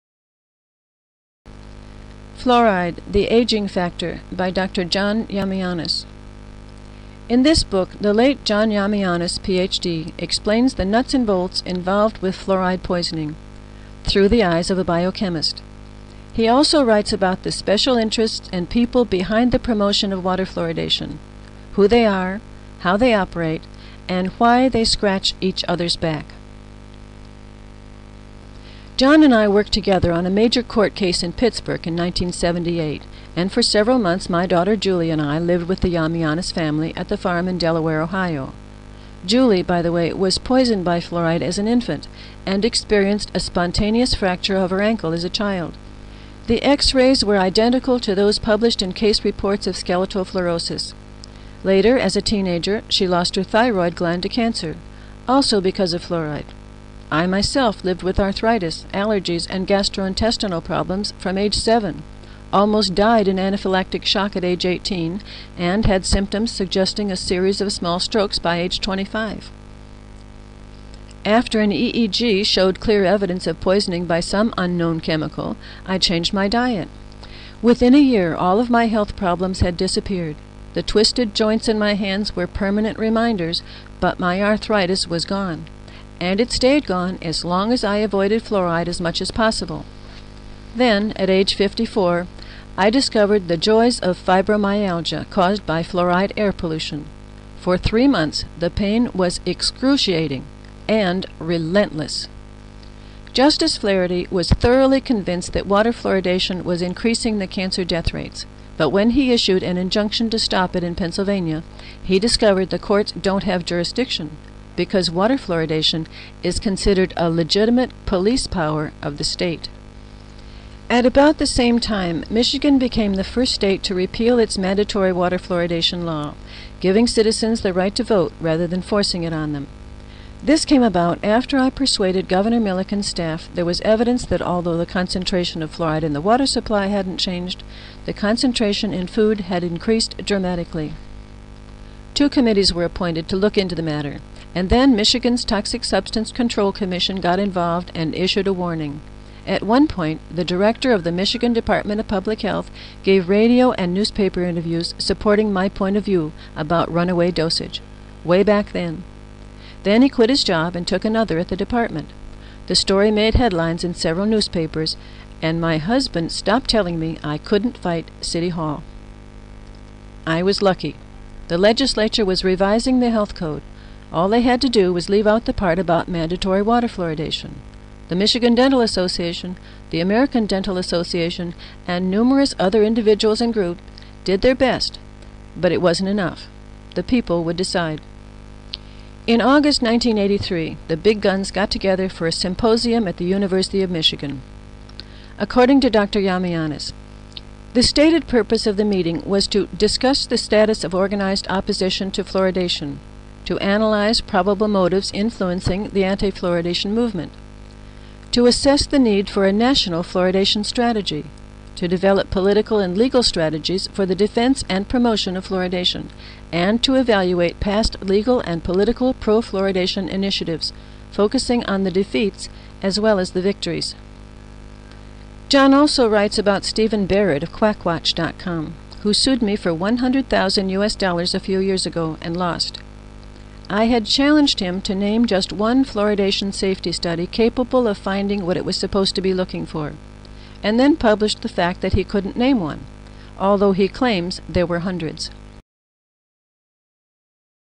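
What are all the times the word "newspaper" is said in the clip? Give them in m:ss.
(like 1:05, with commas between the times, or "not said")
2:33, 2:44.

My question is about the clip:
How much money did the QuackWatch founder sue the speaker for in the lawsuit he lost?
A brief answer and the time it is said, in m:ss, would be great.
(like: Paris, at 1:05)
$100,000, at 3:49.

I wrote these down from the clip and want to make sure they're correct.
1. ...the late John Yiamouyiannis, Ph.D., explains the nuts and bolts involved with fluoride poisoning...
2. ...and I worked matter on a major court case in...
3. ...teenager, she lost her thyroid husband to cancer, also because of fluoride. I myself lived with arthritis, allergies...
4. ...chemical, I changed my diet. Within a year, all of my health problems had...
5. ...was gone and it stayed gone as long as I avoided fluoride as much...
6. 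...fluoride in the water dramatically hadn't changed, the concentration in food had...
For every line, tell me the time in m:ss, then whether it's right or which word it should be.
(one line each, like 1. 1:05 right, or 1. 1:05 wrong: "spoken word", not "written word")
1. 0:08 right
2. 0:29 wrong: "together", not "matter"
3. 0:52 wrong: "gland", not "husband"
4. 1:15 right
5. 1:25 right
6. 2:15 wrong: "supply", not "dramatically".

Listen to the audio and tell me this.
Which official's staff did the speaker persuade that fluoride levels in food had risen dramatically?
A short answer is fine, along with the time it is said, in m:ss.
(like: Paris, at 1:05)
Governor Milliken, at 2:12.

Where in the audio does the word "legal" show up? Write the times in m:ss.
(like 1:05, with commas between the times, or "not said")
3:32, 3:38.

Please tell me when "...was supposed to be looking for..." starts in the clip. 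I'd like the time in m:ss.
3:58.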